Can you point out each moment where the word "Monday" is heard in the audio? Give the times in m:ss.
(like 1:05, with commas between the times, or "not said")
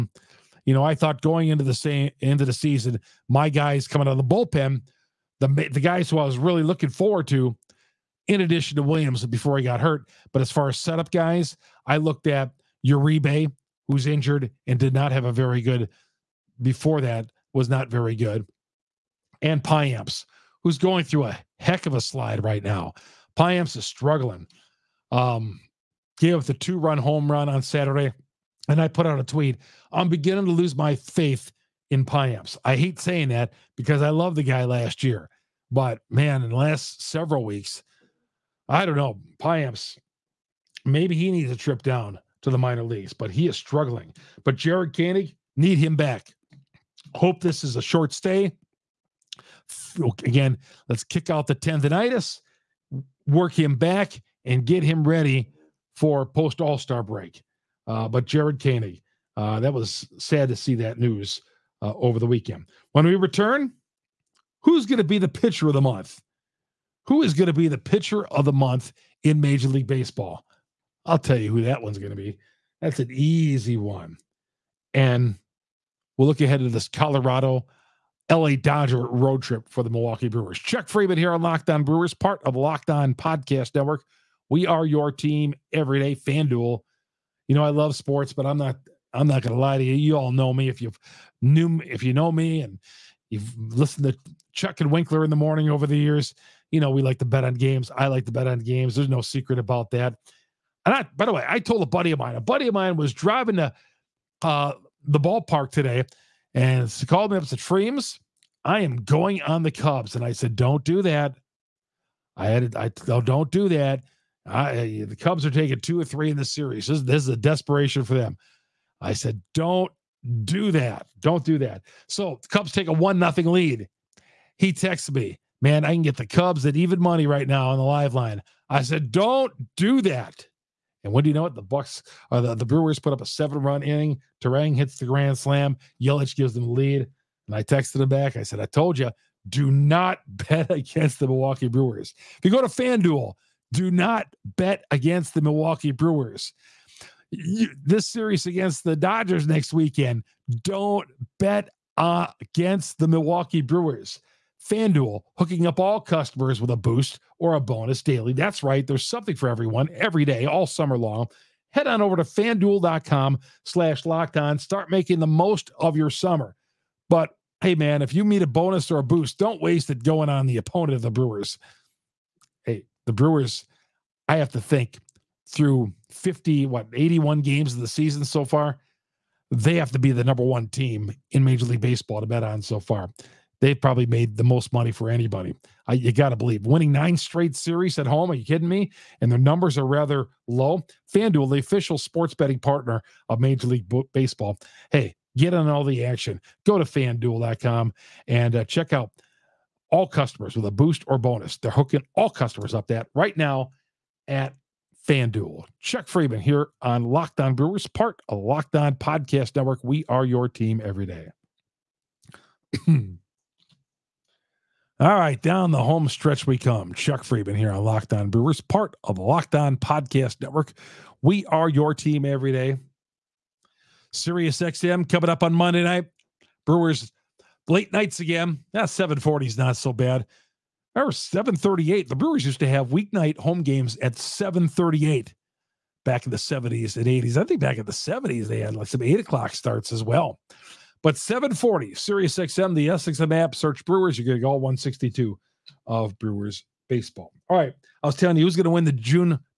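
3:45.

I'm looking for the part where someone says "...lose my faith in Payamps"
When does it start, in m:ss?
0:30.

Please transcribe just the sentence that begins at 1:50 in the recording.
And I said, Don't do that.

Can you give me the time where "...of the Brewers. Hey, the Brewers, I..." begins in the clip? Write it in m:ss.
2:50.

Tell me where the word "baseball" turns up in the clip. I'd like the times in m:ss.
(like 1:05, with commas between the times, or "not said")
1:09, 3:01, 3:14, 4:06.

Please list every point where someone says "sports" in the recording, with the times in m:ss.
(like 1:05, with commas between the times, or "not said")
1:27, 3:11.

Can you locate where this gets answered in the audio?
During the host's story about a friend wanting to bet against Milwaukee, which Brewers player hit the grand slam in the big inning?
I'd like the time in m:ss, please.
2:14.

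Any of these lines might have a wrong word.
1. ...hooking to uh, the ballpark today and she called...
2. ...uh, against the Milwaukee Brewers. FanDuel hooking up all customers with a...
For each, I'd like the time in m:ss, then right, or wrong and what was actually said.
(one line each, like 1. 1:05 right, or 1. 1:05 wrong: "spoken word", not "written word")
1. 1:43 wrong: "driving", not "hooking"
2. 2:31 right.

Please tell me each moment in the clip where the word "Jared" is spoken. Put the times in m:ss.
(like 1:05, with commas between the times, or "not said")
0:44, 0:58.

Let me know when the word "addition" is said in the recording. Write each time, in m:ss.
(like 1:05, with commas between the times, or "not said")
0:08.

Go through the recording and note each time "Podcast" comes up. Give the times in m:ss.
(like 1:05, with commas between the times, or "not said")
1:23, 3:28, 3:39.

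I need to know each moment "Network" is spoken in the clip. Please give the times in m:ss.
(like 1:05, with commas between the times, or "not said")
1:23, 3:29, 3:40.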